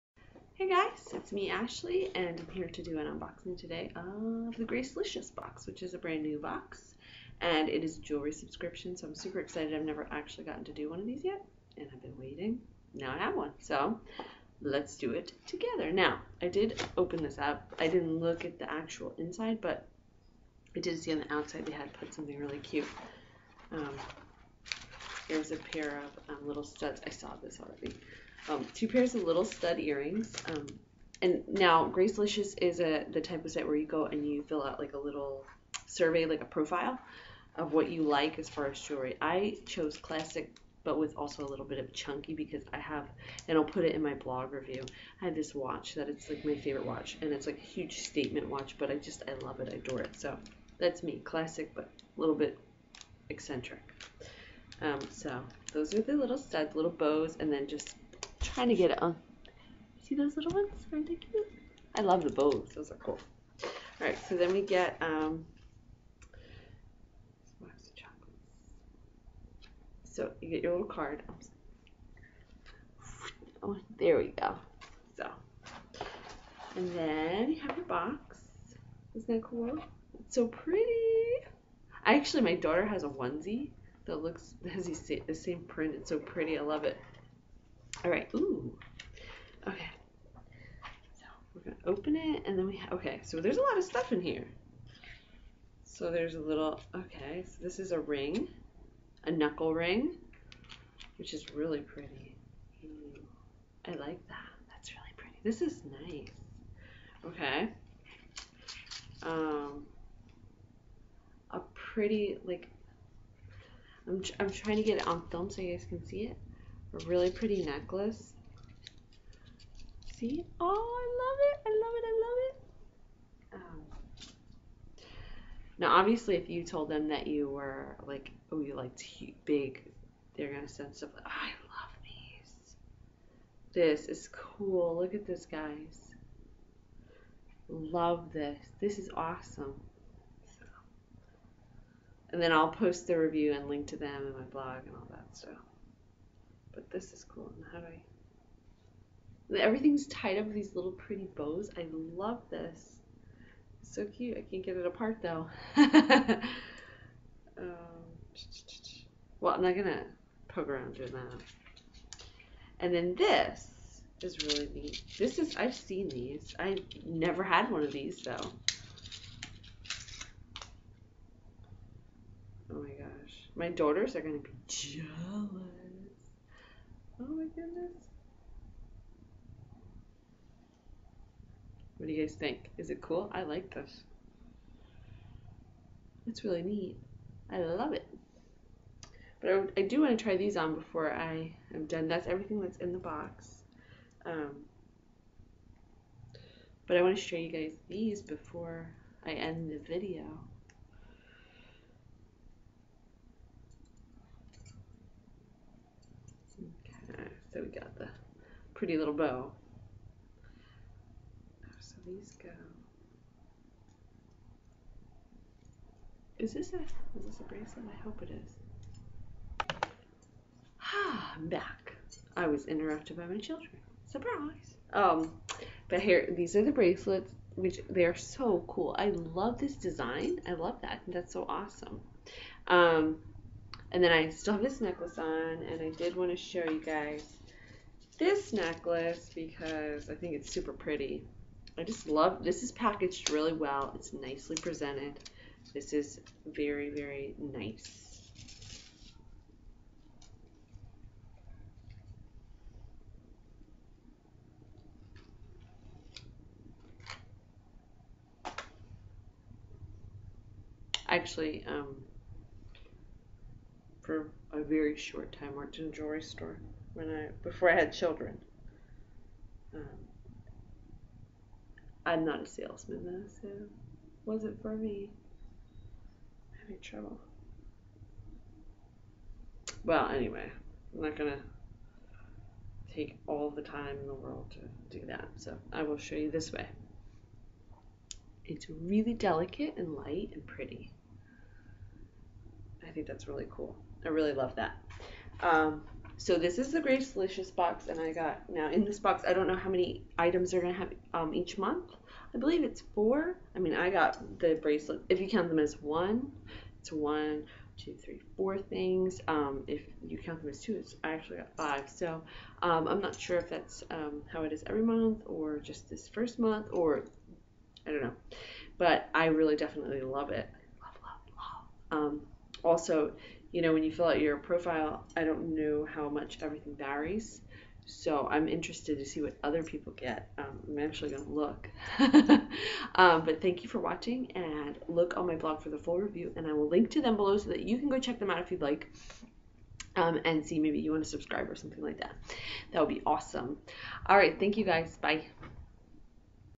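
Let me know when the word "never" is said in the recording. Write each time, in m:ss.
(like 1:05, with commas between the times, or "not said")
0:09, 2:47.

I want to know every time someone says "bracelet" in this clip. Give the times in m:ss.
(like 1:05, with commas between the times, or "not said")
3:37, 3:46, 5:04.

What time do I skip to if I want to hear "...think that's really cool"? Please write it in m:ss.
4:52.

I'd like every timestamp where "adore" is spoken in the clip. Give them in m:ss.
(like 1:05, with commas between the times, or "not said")
0:49.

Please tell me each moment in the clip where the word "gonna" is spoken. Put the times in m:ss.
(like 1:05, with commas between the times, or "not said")
1:31, 2:39, 2:54, 4:41, 5:00.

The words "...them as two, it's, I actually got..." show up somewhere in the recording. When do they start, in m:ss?
5:10.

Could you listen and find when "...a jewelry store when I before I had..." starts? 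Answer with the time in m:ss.
4:25.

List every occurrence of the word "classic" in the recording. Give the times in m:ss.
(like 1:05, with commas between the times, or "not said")
0:39, 0:51.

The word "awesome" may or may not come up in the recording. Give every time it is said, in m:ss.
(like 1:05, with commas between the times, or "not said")
2:19, 3:51, 5:43.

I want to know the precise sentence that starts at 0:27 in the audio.
I saw this already um, two pairs of little stud earrings.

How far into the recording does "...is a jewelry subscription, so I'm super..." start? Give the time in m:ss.
0:07.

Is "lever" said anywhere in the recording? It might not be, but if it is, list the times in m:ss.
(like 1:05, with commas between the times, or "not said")
not said.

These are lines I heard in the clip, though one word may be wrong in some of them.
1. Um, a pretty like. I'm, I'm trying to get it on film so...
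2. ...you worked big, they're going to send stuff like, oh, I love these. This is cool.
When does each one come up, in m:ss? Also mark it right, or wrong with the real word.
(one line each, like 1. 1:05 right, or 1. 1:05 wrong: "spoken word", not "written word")
1. 1:49 right
2. 2:08 wrong: "liked", not "worked".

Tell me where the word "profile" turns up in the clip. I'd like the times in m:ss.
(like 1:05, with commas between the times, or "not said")
0:36, 5:24.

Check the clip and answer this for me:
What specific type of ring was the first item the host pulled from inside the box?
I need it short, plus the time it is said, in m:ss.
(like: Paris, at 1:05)
Knuckle ring, at 1:39.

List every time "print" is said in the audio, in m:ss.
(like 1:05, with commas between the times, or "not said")
1:25.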